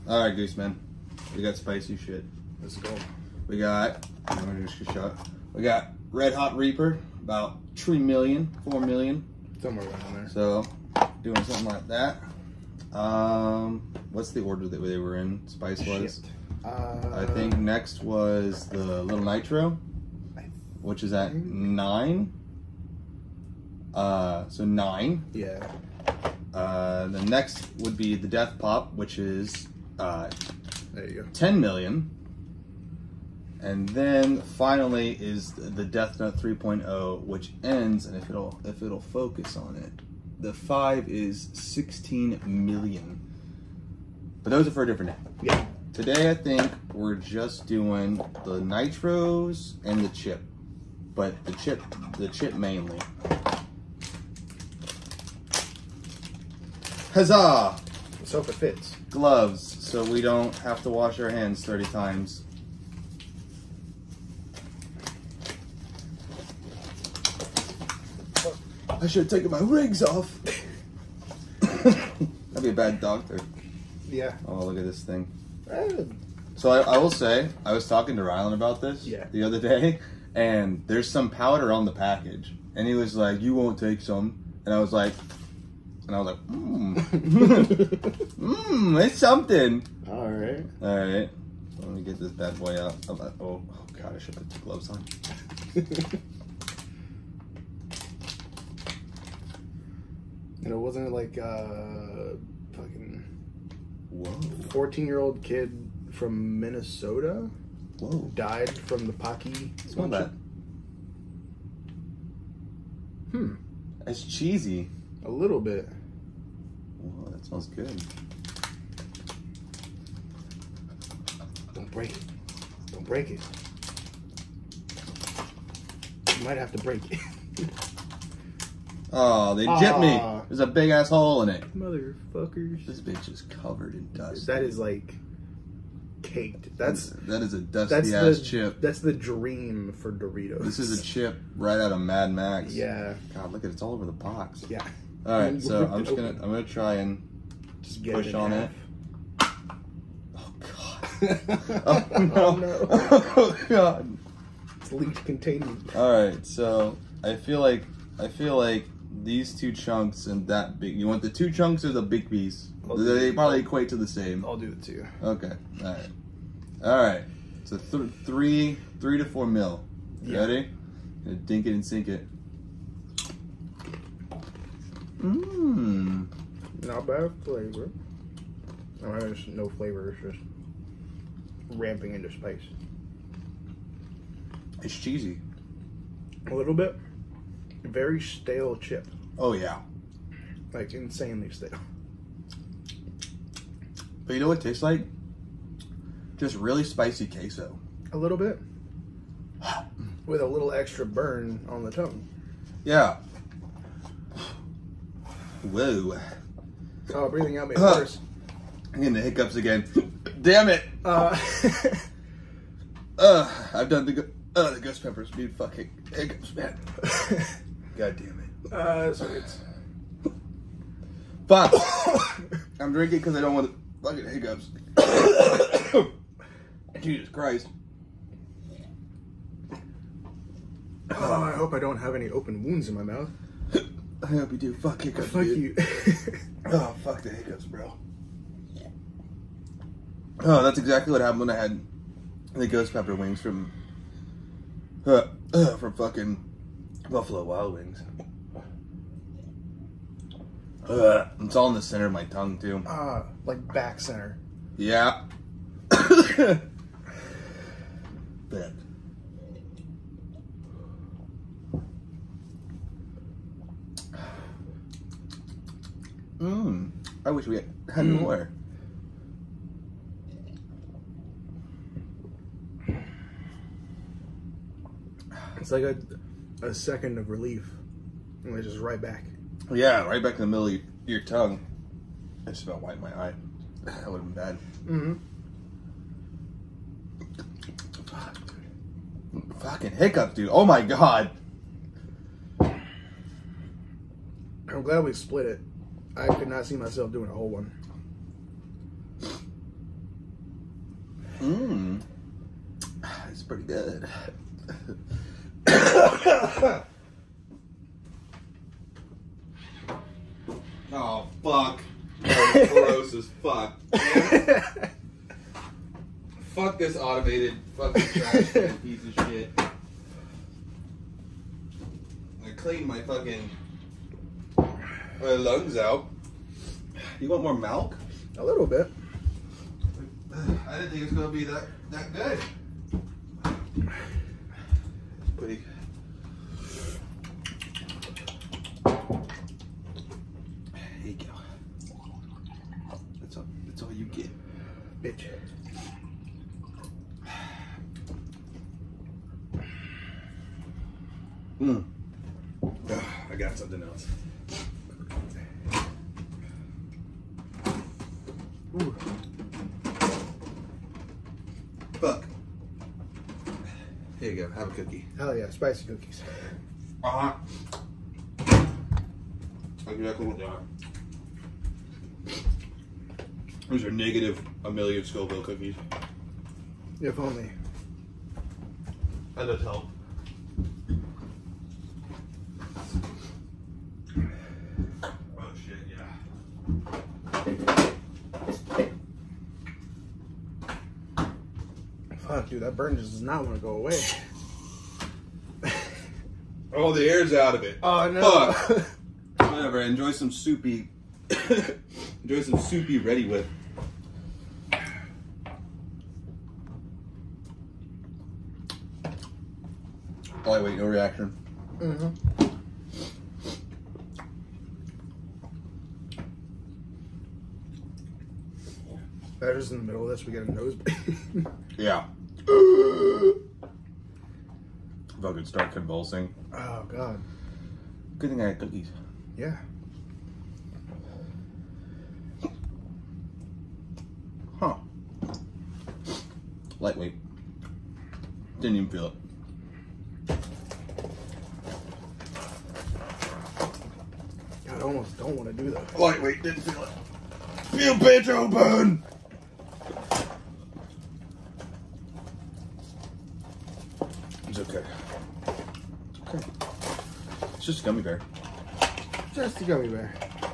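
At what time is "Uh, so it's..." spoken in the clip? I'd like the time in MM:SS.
03:38.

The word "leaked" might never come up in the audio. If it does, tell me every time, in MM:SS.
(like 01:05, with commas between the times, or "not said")
02:34.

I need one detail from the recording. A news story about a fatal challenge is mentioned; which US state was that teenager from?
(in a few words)
Minnesota.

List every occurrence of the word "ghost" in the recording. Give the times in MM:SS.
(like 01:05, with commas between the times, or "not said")
03:34, 04:02.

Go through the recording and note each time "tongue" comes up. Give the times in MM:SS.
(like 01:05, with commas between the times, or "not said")
03:21, 04:12, 04:41.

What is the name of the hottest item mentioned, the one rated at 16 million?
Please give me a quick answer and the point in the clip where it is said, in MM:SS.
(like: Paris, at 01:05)
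Death Nut 3.0, at 00:35.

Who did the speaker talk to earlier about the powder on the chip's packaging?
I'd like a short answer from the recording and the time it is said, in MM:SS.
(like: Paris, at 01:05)
Rylan, at 01:18.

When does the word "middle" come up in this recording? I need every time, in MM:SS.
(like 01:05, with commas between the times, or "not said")
04:40, 06:59.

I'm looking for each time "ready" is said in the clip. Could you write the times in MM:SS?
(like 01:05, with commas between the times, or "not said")
02:50, 06:42.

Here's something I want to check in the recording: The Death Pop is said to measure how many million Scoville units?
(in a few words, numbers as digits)
10 million.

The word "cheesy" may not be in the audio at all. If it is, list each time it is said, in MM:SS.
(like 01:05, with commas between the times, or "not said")
01:54, 03:04.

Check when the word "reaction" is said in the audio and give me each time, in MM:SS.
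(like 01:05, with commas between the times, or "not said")
06:50.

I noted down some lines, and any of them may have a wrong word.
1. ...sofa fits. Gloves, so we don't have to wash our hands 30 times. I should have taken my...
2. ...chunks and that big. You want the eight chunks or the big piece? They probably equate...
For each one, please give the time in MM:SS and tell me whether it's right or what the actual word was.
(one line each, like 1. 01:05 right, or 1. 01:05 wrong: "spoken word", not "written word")
1. 00:58 right
2. 02:39 wrong: "two", not "eight".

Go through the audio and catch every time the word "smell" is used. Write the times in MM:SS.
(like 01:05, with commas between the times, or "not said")
01:49, 01:57.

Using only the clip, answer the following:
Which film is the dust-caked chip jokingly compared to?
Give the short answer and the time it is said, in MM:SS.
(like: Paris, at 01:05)
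Mad Max, at 02:21.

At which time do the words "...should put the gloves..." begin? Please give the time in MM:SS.
01:34.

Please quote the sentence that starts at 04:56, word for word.
I could not see myself doing a whole one.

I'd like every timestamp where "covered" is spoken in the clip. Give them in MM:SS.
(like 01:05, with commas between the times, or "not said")
02:13.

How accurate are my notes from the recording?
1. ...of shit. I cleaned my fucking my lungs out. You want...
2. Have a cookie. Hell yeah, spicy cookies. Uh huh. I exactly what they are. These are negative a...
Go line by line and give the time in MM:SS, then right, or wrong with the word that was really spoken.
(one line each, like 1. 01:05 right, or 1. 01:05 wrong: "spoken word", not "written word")
1. 05:19 right
2. 06:04 right.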